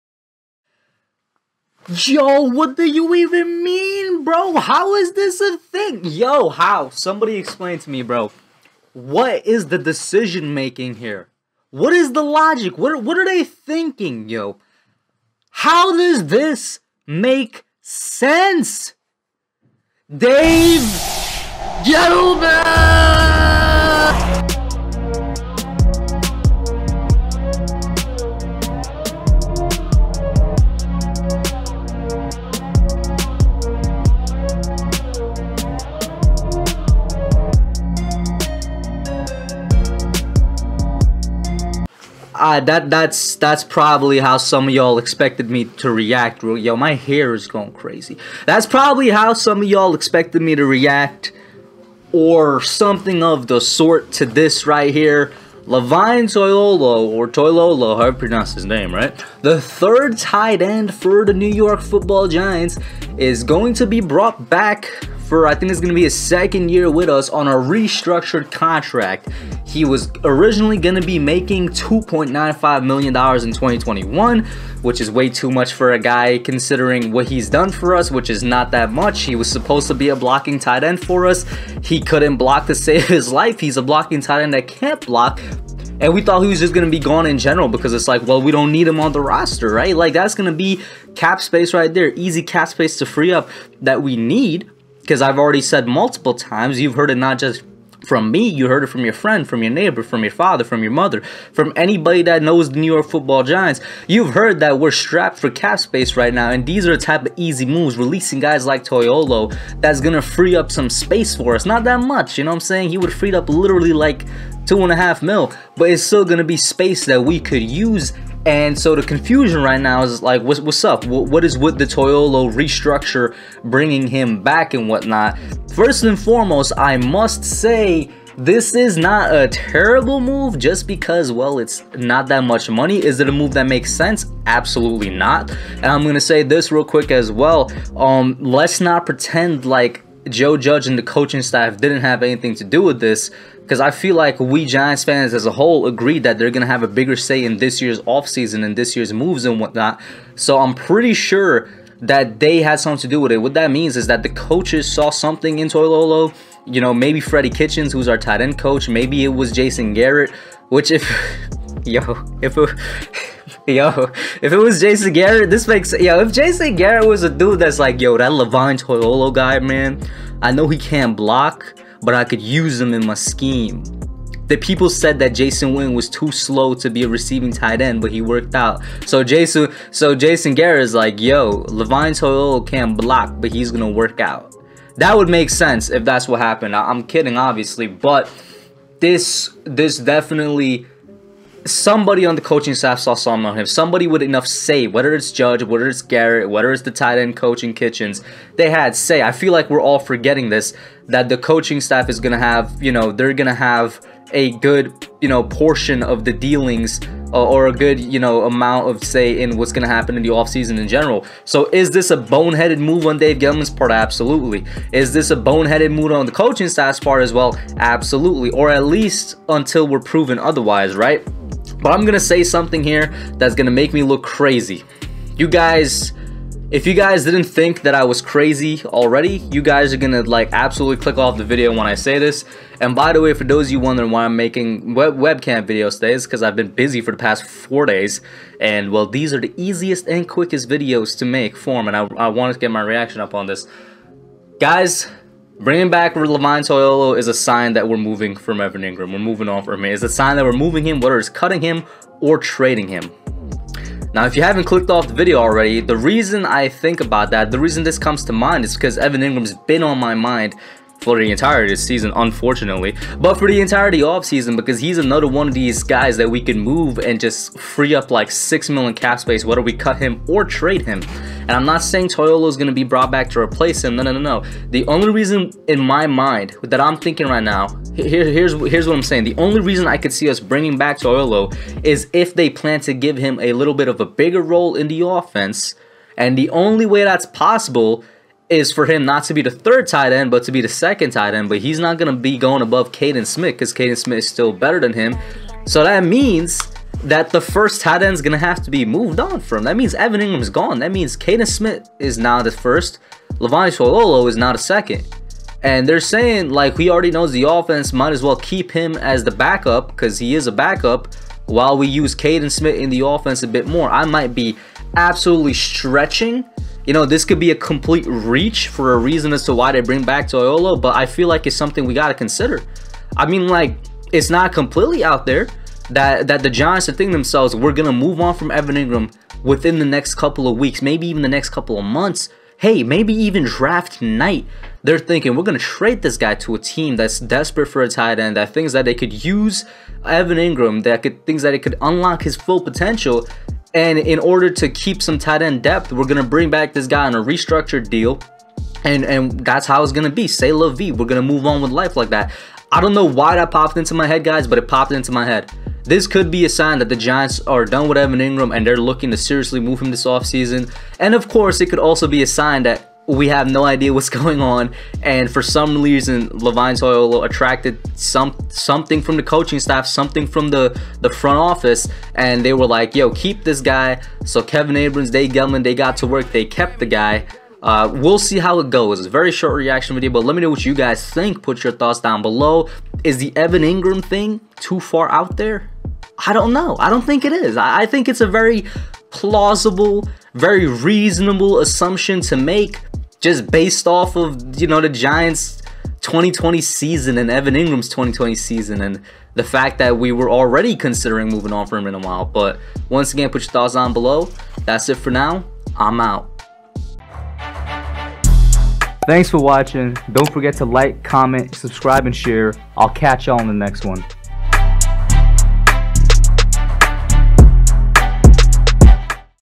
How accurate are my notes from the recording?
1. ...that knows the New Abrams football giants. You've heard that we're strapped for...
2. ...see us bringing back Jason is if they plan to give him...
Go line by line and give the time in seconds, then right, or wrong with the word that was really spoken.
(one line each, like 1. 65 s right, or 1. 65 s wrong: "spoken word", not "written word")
1. 102 s wrong: "York", not "Abrams"
2. 280 s wrong: "Toilolo", not "Jason".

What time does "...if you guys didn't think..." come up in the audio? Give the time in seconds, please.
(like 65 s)
226 s.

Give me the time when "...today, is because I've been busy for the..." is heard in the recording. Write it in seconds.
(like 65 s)
235 s.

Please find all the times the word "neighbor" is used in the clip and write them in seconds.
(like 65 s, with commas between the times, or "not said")
99 s.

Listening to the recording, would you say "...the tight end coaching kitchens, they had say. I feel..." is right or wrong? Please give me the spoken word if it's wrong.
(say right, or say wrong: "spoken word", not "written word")
right.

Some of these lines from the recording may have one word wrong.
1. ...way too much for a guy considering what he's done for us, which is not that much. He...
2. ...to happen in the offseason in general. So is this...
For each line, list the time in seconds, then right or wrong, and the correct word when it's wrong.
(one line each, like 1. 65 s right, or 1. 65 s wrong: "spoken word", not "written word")
1. 75 s right
2. 209 s right.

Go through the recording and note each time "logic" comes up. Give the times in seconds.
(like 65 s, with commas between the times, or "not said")
12 s.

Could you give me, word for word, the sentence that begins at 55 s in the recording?
Levine Toilolo, or Toilolo, however you pronounce his name, right?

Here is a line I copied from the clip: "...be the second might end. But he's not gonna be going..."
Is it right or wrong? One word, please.
wrong.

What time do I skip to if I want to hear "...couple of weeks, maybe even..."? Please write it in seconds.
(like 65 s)
330 s.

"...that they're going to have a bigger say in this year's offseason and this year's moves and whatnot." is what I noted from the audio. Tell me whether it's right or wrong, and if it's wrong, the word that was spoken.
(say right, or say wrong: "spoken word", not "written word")
right.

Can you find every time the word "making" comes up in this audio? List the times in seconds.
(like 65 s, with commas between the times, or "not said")
10 s, 71 s, 234 s.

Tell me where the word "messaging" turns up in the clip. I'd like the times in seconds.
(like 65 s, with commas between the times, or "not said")
not said.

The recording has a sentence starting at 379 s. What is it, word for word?
very short reaction video, but let me know what you guys think.